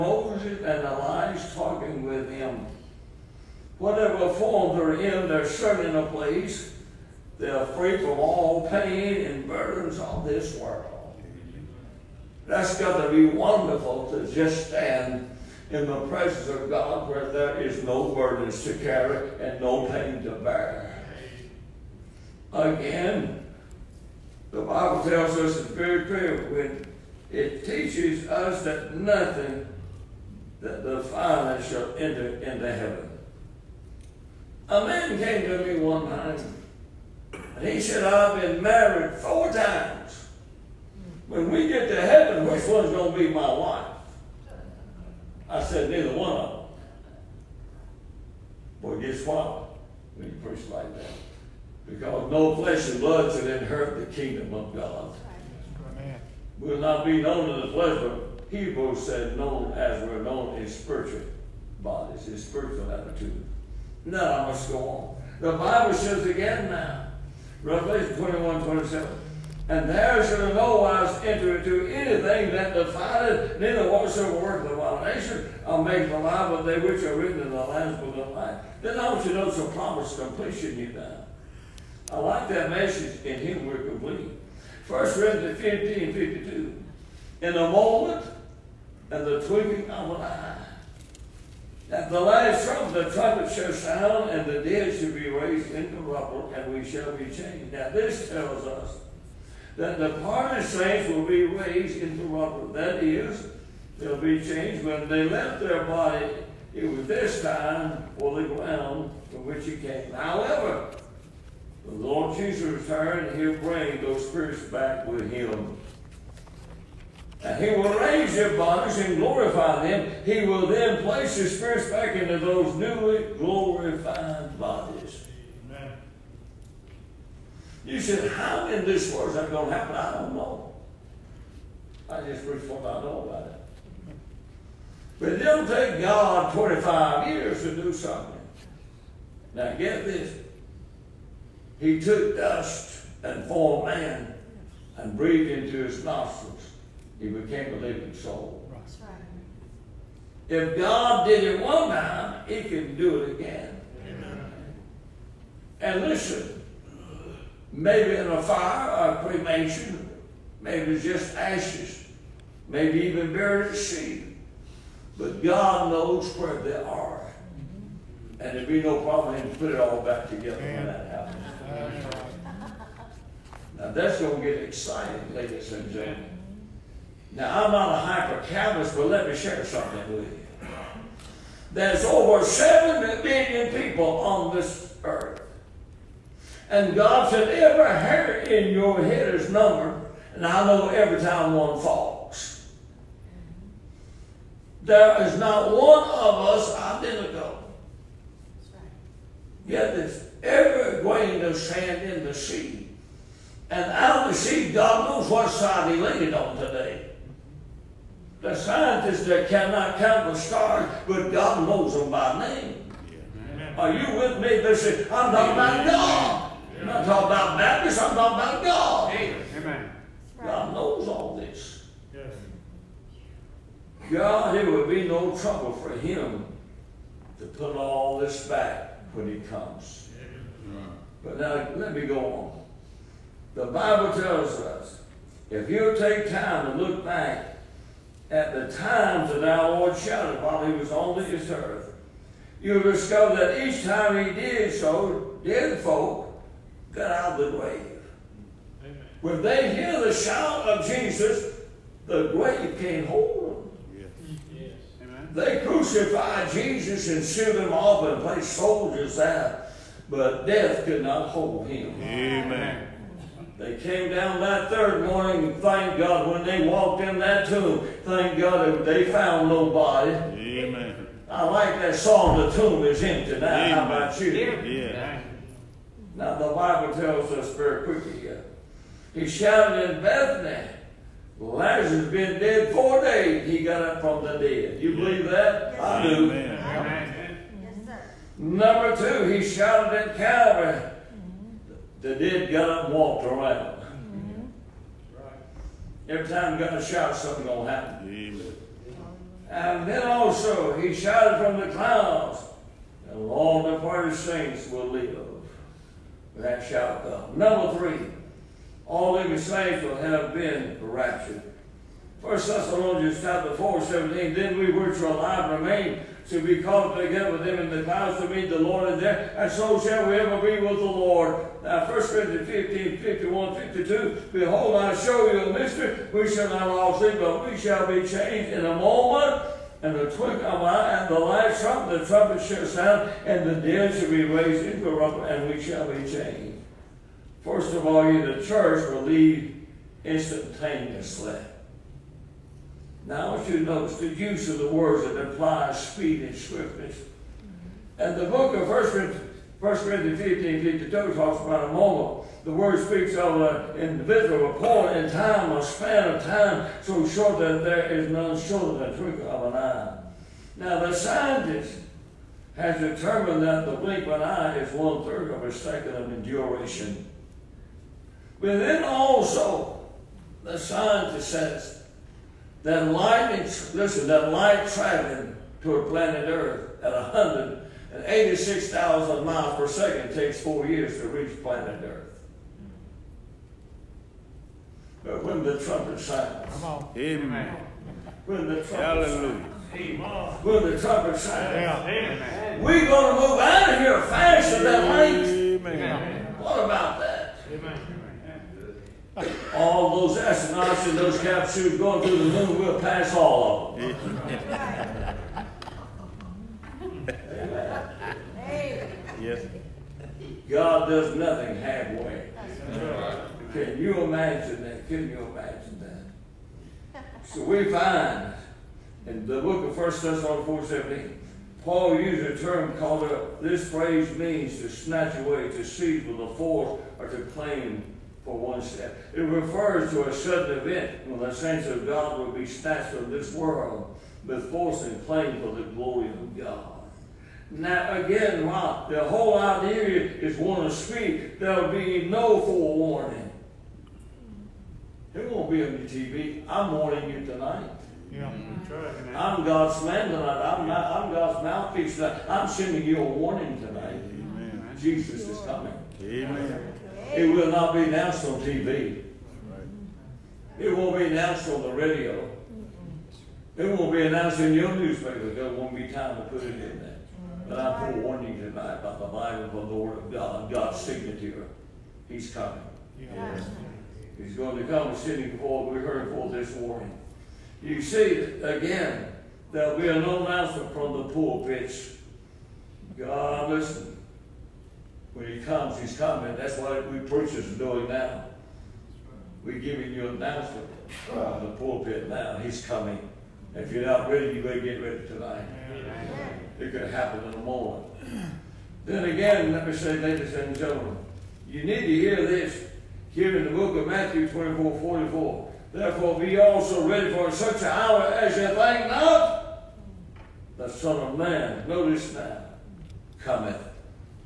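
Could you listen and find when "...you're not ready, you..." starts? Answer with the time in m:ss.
8:13.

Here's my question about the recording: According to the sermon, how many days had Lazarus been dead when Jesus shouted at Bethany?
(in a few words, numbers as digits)
4 days.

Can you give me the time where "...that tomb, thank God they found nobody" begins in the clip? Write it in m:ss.
4:27.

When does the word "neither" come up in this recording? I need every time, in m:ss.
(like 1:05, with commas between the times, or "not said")
0:45, 1:13.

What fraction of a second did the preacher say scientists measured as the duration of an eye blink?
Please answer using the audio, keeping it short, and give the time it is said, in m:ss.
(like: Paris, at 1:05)
one third, at 6:04.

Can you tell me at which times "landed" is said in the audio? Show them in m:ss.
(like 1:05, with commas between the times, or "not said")
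3:26.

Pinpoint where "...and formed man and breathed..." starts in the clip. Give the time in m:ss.
2:23.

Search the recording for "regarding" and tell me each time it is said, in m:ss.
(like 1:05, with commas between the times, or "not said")
not said.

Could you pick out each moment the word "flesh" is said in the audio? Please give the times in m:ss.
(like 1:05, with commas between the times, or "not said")
0:52, 0:57.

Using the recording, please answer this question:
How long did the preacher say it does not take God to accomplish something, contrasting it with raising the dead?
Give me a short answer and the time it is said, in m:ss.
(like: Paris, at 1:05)
25 years, at 2:16.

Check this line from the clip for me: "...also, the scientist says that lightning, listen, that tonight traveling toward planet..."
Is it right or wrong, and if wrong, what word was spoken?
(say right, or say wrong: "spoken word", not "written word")
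wrong: "light", not "tonight".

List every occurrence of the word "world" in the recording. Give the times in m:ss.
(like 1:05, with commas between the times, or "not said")
0:10, 2:09, 7:13.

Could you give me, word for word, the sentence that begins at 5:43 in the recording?
Now you notice the use of the words that implies speed and swiftness.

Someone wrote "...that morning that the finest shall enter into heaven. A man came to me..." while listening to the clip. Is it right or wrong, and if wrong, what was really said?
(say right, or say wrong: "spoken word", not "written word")
wrong: "nothing", not "morning".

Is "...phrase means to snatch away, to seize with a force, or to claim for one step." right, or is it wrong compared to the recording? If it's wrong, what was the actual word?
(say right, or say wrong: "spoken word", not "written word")
right.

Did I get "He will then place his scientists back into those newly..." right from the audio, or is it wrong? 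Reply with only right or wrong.
wrong.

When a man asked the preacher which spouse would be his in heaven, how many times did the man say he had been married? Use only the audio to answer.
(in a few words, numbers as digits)
4.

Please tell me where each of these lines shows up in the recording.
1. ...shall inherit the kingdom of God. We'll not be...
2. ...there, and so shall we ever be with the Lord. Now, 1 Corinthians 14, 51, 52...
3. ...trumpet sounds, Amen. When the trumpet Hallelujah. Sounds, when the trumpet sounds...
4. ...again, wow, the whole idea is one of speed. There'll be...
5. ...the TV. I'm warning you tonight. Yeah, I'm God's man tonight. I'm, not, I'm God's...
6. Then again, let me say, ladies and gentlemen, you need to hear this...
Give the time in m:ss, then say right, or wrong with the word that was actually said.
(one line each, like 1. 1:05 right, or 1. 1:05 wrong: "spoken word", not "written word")
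1. 0:53 right
2. 5:19 wrong: "15", not "14"
3. 6:25 right
4. 7:18 right
5. 7:25 right
6. 8:18 right.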